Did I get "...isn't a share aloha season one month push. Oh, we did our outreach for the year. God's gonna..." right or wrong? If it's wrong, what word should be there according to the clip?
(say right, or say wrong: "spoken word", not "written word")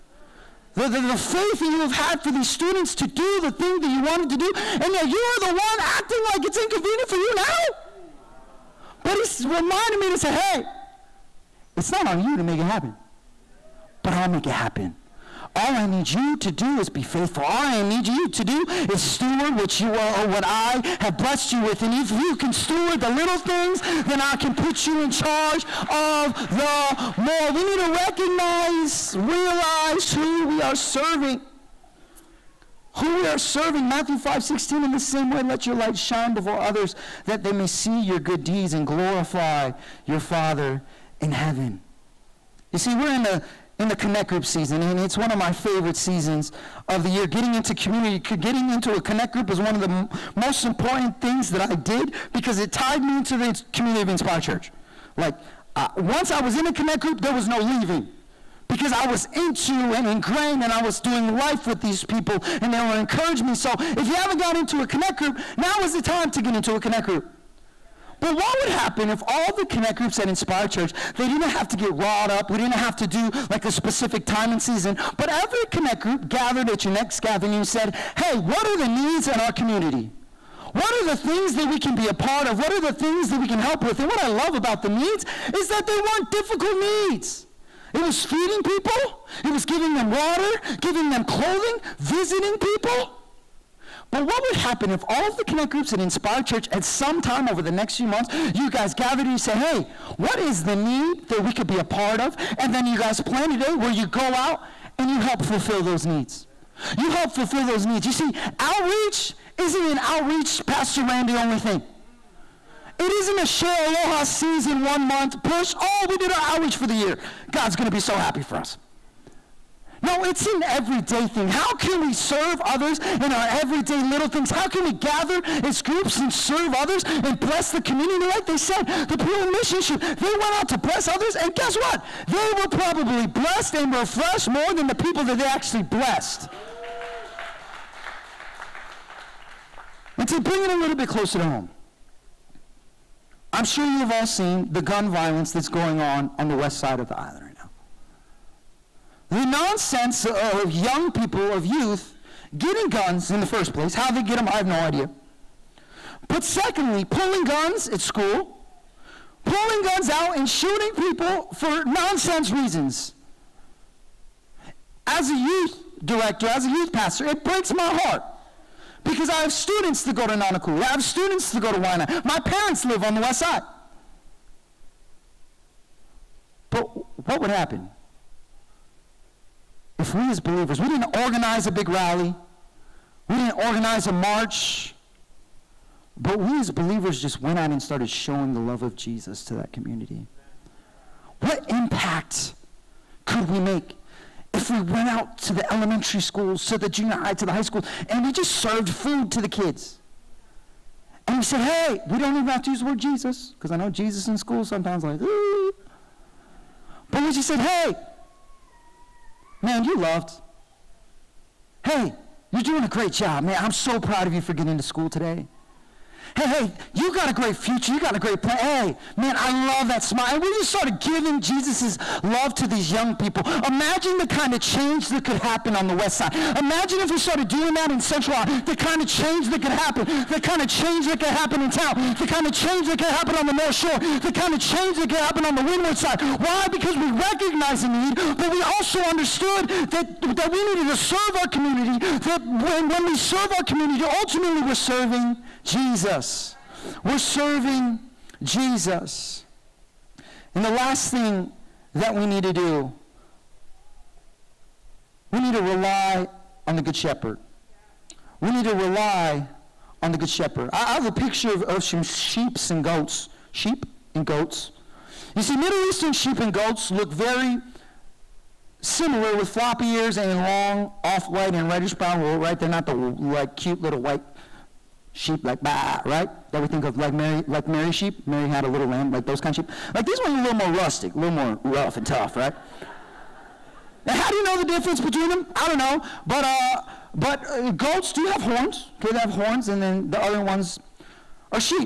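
right.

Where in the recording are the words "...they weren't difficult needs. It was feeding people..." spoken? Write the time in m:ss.
1:25.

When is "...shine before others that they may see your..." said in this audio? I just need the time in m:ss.
0:35.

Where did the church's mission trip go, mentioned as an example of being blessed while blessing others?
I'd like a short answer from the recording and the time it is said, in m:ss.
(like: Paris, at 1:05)
Peru, at 2:09.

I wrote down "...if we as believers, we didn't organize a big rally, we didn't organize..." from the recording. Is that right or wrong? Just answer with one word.
right.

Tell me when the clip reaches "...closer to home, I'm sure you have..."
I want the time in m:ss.
2:21.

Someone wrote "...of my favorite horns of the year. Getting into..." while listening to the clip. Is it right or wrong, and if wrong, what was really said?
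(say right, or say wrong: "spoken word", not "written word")
wrong: "seasons", not "horns".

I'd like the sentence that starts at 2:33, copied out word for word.
How they get them, I have no idea.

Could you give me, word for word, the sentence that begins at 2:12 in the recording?
They were probably blessed and refreshed more than the people that they actually blessed.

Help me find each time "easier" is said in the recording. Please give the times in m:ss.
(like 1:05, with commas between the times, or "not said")
not said.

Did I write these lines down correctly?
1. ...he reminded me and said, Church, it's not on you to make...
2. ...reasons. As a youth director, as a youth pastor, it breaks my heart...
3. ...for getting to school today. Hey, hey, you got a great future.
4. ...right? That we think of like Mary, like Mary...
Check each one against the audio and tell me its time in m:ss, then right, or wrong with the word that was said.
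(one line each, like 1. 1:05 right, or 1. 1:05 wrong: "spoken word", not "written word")
1. 0:09 wrong: "Hey", not "Church"
2. 2:42 right
3. 3:34 right
4. 4:36 right.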